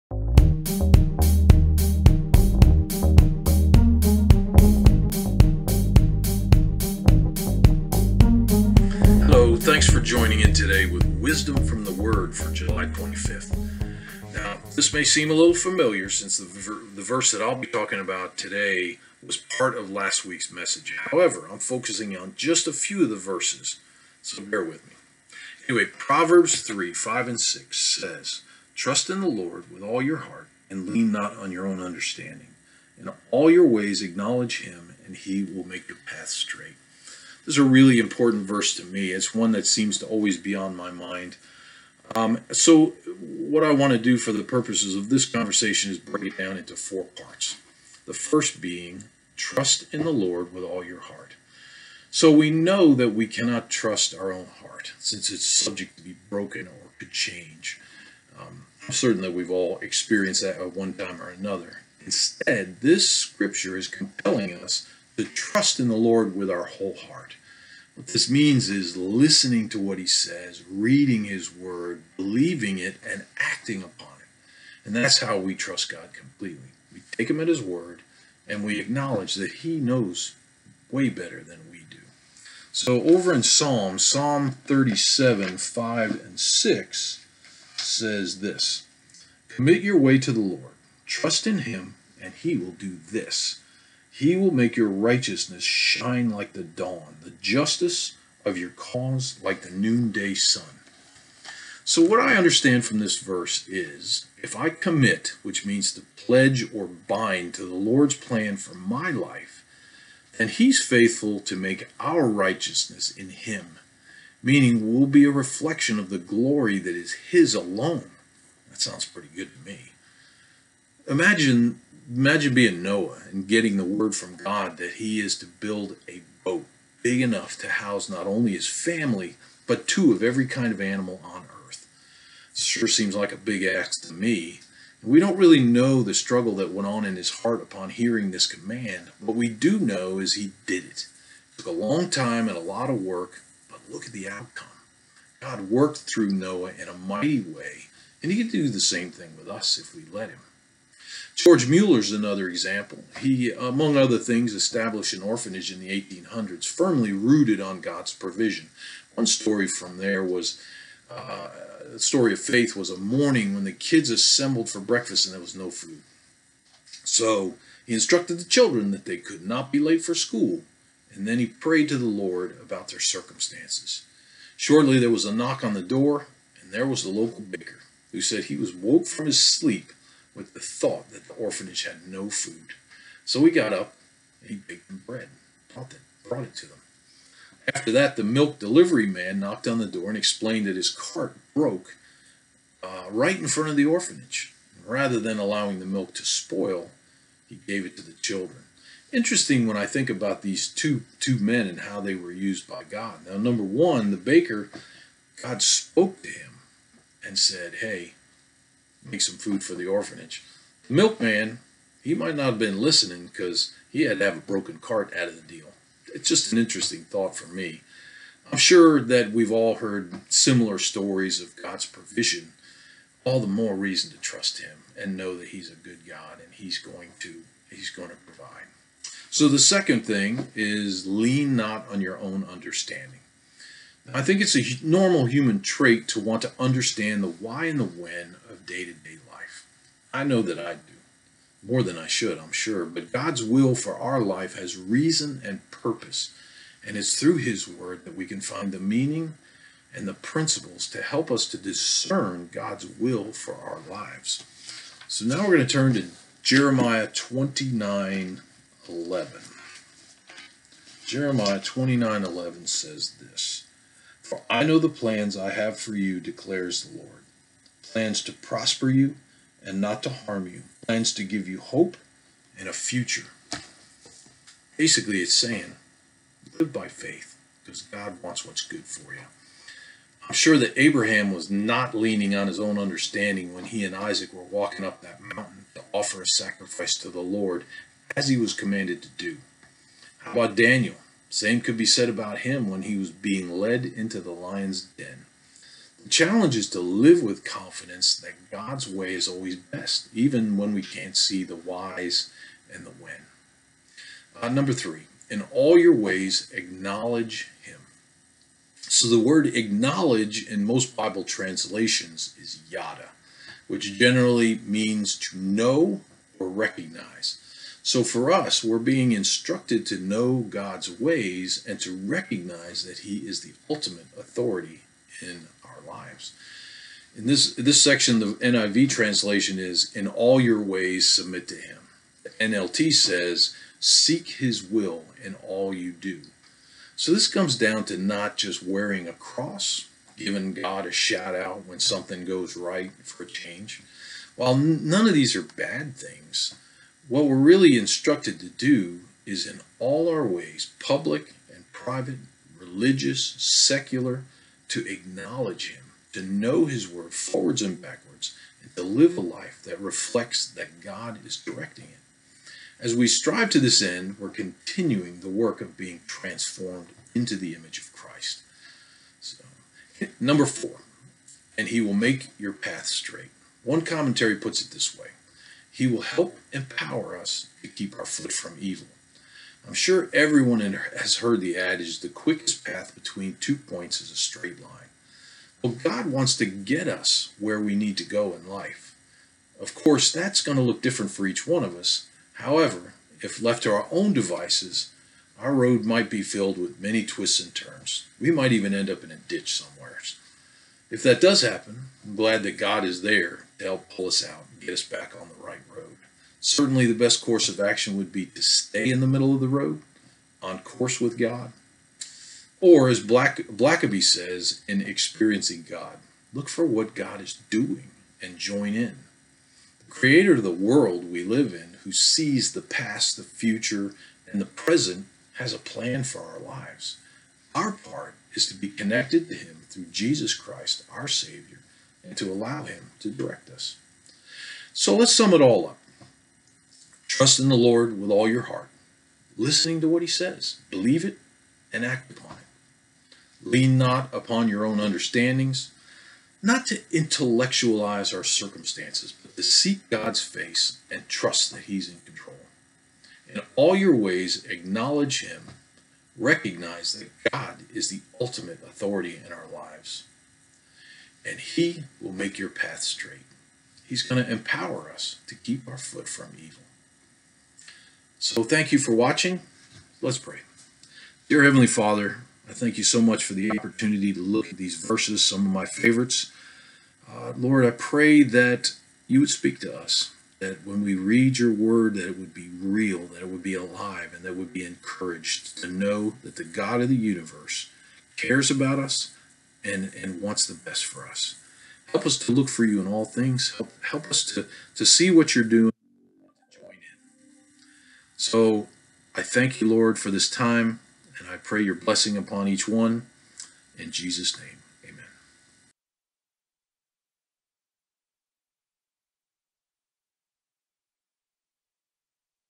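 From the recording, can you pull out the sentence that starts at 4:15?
So now we're going to turn to Jeremiah 29 11.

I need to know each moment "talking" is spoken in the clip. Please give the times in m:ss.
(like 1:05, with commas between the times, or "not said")
0:17.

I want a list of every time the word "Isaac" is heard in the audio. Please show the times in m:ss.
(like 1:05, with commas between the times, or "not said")
4:43.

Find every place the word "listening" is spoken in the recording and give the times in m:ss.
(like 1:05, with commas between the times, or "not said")
1:08, 3:32, 7:19.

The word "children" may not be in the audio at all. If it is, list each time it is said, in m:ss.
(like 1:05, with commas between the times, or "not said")
2:48, 3:18.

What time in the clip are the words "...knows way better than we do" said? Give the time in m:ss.
1:19.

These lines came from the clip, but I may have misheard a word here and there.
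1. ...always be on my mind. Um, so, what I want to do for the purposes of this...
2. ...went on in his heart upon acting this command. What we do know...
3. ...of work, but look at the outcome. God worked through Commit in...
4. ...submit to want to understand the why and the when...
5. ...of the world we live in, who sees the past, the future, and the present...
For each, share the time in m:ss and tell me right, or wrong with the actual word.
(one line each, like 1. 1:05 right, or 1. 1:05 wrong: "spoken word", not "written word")
1. 0:40 right
2. 2:16 wrong: "hearing", not "acting"
3. 2:22 wrong: "Noah", not "Commit"
4. 3:55 wrong: "trait", not "submit"
5. 7:00 right.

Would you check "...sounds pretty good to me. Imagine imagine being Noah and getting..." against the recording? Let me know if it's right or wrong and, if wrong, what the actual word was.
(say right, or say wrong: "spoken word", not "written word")
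right.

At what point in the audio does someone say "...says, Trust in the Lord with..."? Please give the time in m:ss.
0:27.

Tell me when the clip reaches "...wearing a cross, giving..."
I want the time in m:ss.
5:38.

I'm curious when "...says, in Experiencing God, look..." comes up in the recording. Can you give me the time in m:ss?
6:54.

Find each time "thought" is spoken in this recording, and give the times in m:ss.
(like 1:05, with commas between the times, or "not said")
3:00, 3:37.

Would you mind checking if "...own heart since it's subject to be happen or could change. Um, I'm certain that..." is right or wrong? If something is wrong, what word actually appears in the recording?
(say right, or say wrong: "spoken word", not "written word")
wrong: "broken", not "happen".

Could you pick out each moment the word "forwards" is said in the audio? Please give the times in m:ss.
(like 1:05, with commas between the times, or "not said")
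5:57.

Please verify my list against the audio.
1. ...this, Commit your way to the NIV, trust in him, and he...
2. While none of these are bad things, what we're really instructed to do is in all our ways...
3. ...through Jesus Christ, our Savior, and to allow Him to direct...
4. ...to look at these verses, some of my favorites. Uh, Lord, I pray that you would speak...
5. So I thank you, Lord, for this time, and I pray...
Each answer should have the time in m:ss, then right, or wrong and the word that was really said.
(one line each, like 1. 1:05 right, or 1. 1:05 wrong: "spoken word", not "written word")
1. 1:28 wrong: "Lord", not "NIV"
2. 5:44 right
3. 7:09 right
4. 7:54 right
5. 8:18 right.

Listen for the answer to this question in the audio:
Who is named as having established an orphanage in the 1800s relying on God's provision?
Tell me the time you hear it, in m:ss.
2:31.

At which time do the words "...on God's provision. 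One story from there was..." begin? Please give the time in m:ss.
2:37.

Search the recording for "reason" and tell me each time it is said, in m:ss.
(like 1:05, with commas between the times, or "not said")
3:43, 4:04.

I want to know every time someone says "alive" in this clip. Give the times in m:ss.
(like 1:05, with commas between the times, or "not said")
8:03.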